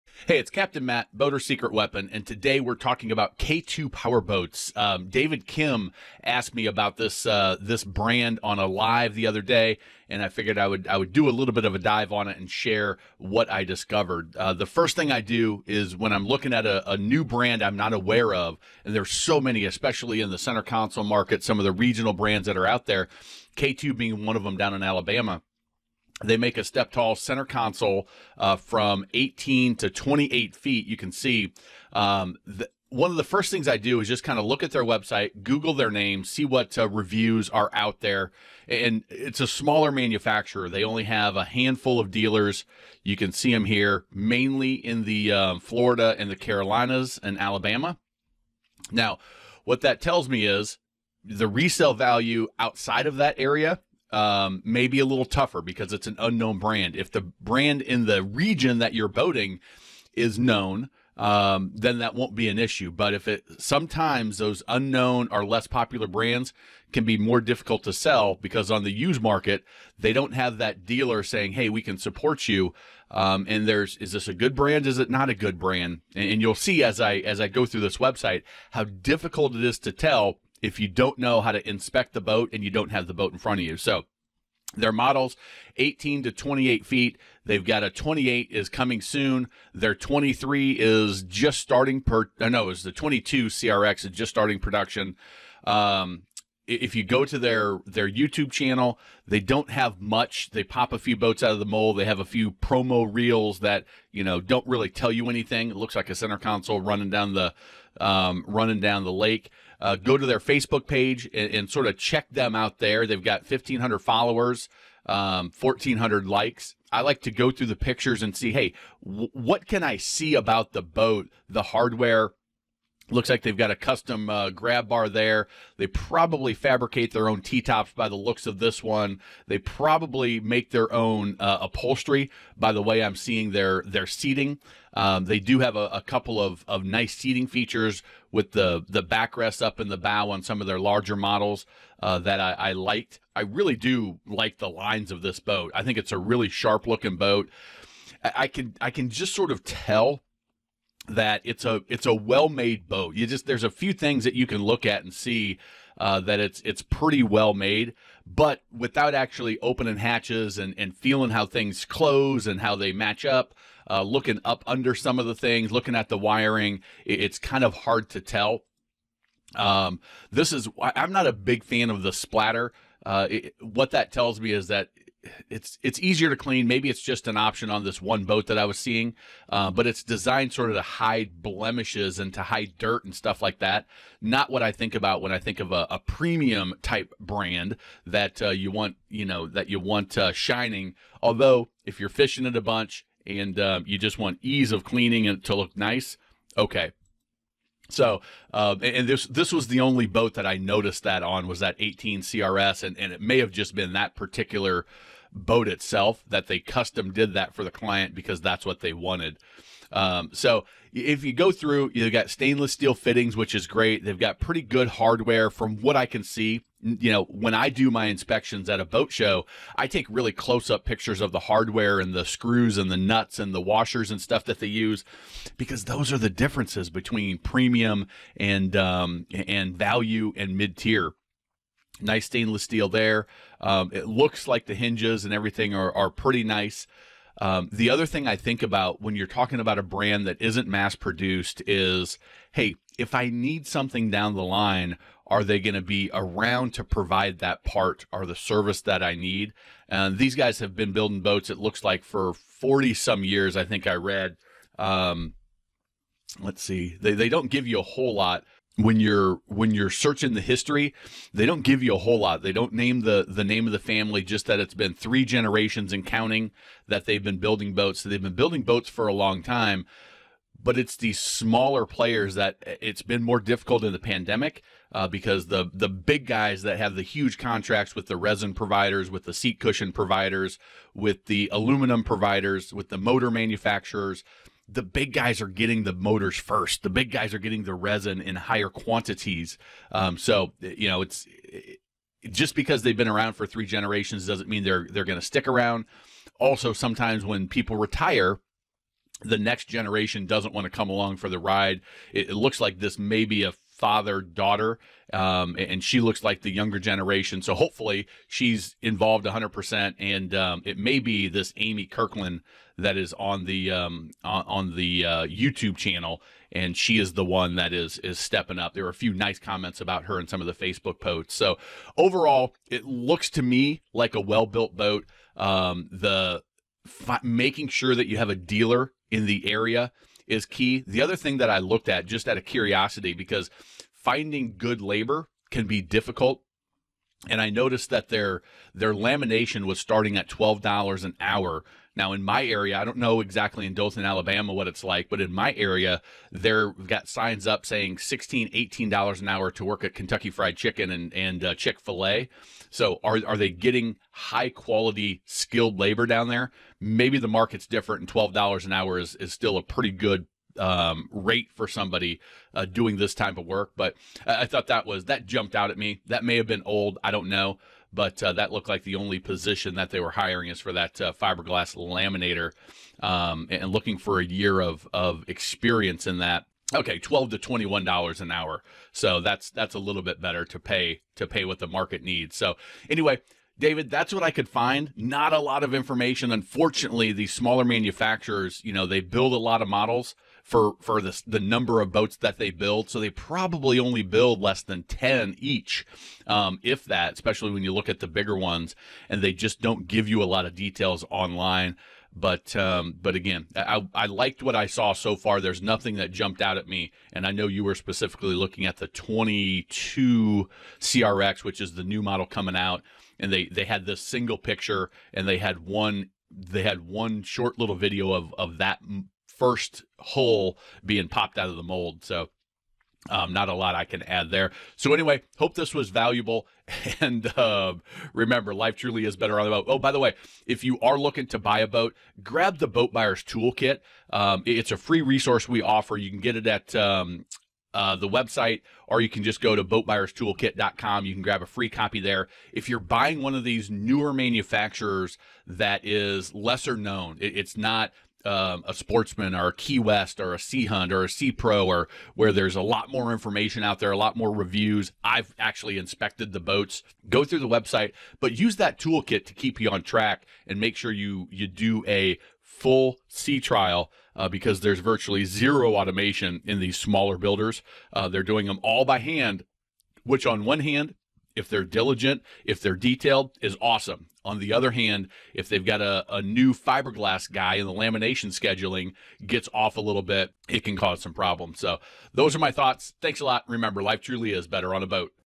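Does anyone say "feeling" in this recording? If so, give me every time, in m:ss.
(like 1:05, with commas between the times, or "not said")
2:40.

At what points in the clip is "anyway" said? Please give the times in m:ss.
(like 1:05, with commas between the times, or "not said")
6:22, 7:04.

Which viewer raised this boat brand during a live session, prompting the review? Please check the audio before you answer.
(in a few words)
David Kim.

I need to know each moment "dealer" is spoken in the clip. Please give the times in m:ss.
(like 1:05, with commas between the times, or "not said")
0:42, 1:10, 5:28.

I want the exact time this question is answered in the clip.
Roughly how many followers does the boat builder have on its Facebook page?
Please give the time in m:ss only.
1:53.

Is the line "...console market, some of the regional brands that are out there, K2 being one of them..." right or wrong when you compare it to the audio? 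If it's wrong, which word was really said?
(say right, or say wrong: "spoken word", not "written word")
right.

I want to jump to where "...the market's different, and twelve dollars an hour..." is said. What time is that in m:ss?
5:57.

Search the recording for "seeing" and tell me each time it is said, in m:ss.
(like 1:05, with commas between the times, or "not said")
2:13, 2:58.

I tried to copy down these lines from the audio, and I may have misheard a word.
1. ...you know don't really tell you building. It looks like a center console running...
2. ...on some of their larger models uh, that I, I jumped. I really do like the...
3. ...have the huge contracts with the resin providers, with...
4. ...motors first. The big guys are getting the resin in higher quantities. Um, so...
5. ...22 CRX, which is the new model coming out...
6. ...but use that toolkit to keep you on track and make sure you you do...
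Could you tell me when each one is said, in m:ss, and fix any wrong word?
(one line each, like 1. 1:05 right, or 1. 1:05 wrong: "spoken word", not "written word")
1. 1:44 wrong: "anything", not "building"
2. 2:20 wrong: "liked", not "jumped"
3. 4:36 right
4. 4:45 right
5. 6:48 right
6. 7:38 right.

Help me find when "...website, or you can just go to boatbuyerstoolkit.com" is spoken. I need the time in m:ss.
7:18.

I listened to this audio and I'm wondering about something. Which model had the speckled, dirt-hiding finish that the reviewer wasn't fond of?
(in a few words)
18 CRS.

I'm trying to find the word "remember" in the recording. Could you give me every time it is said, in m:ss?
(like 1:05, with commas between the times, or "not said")
7:08, 8:03.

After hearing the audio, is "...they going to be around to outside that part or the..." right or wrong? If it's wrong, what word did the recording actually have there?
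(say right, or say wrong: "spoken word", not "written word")
wrong: "provide", not "outside".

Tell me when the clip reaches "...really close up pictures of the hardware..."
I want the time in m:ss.
3:40.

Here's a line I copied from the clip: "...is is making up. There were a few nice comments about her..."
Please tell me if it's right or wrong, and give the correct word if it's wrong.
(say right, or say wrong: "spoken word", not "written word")
wrong: "stepping", not "making".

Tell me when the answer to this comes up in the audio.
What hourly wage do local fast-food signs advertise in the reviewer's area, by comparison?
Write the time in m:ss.
5:47.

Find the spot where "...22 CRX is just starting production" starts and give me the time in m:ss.
1:32.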